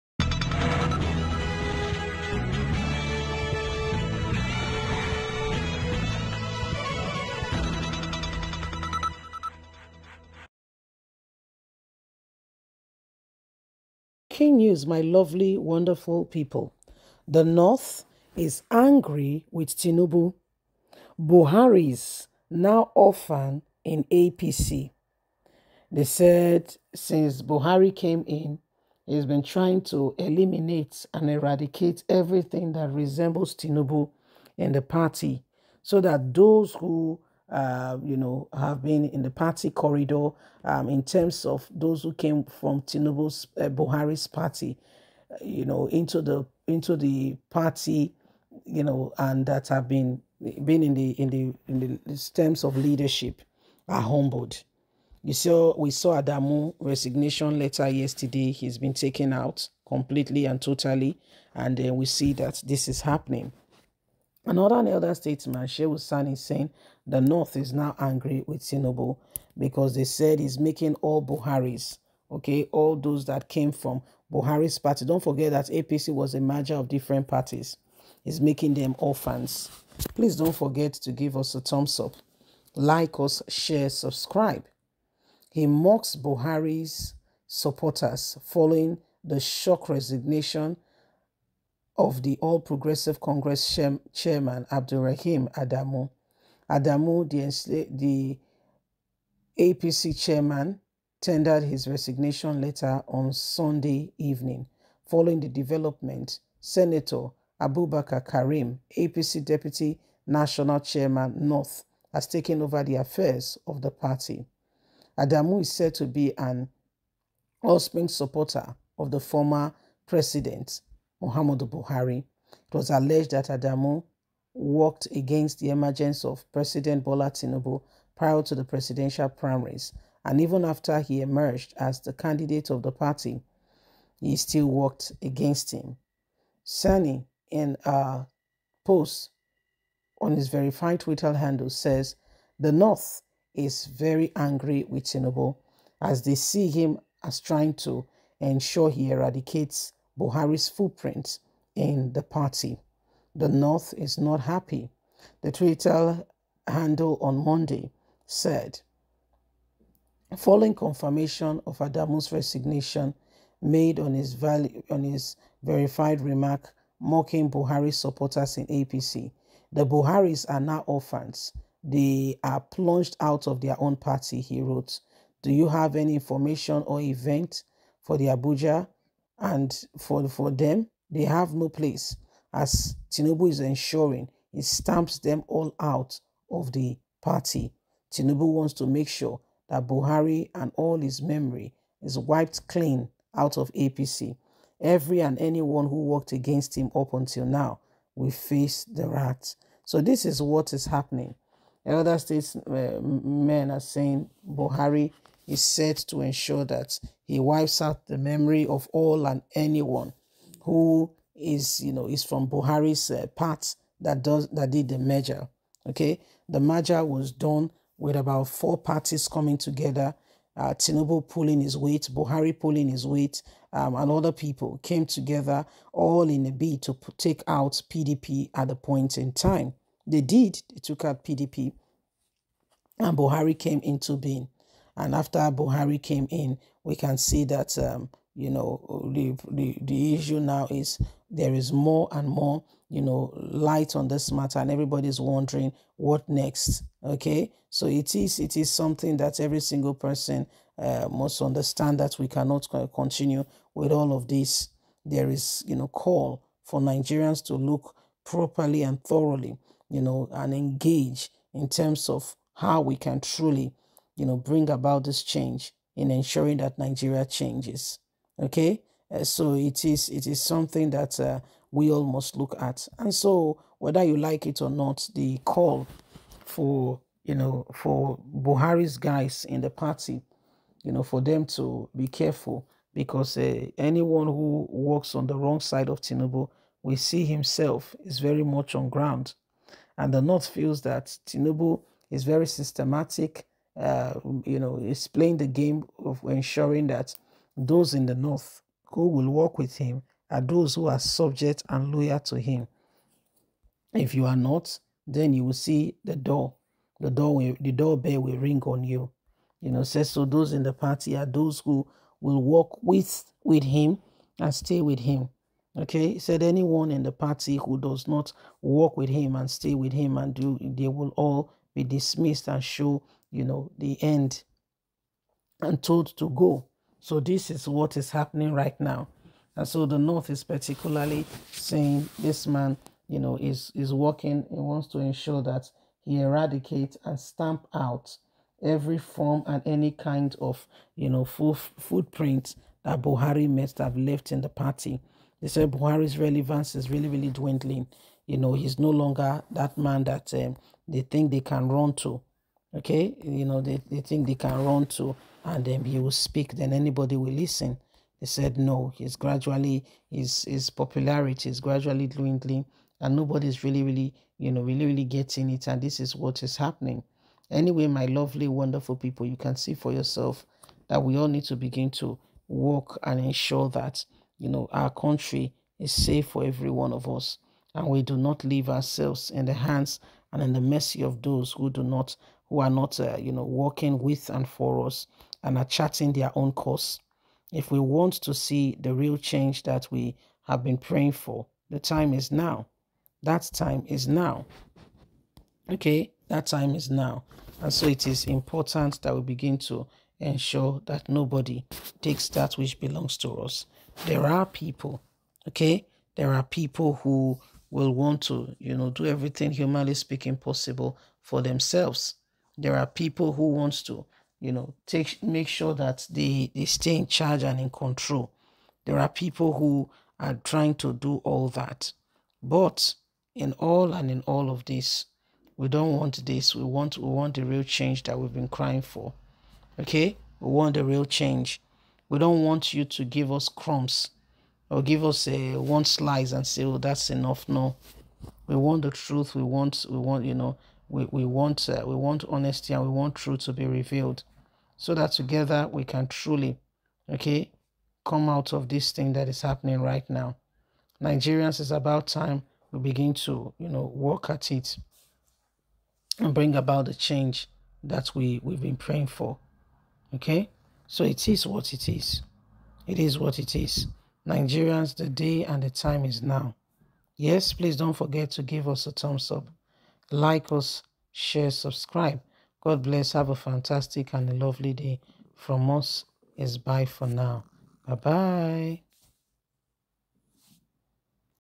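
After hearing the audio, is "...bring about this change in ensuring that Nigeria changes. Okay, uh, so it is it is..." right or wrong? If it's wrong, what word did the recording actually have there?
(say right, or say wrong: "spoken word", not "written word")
right.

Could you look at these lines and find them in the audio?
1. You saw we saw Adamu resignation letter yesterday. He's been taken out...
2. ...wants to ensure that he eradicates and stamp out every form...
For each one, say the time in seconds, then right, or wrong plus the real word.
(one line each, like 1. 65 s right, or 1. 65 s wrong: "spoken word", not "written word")
1. 55 s right
2. 334 s right.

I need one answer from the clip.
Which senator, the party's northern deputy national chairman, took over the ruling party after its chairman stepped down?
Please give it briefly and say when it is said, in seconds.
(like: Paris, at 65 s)
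Abubakar Karim, at 107 s.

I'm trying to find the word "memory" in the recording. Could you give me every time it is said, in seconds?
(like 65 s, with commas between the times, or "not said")
191 s, 208 s.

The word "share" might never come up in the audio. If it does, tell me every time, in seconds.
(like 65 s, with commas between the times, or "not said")
83 s, 471 s.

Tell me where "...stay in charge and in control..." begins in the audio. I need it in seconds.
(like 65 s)
416 s.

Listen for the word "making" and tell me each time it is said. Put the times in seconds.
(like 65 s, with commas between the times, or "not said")
70 s, 78 s.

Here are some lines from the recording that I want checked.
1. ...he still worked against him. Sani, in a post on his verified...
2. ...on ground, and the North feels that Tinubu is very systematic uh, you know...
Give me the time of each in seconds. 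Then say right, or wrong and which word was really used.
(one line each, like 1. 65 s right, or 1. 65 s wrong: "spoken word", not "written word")
1. 134 s right
2. 288 s right.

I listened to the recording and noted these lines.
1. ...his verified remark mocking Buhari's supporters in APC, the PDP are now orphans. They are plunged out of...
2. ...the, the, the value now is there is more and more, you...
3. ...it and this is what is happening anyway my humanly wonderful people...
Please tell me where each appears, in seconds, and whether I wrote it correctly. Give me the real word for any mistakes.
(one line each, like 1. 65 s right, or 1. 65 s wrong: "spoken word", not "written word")
1. 165 s wrong: "Buharis", not "PDP"
2. 239 s wrong: "issue", not "value"
3. 365 s wrong: "lovely", not "humanly".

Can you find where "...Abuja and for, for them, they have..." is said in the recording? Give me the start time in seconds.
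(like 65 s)
178 s.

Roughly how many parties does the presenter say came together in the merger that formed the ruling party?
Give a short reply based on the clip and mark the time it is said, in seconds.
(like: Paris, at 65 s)
4, at 218 s.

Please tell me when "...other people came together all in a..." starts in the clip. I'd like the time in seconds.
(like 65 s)
224 s.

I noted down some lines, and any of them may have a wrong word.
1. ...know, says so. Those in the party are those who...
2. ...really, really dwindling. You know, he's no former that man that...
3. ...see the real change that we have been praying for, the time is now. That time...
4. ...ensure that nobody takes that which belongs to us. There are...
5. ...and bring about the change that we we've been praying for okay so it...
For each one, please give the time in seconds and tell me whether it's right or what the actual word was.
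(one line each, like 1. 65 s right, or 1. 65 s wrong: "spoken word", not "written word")
1. 309 s right
2. 346 s wrong: "longer", not "former"
3. 388 s right
4. 400 s right
5. 456 s right.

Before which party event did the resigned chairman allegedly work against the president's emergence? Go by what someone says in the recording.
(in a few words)
presidential primaries.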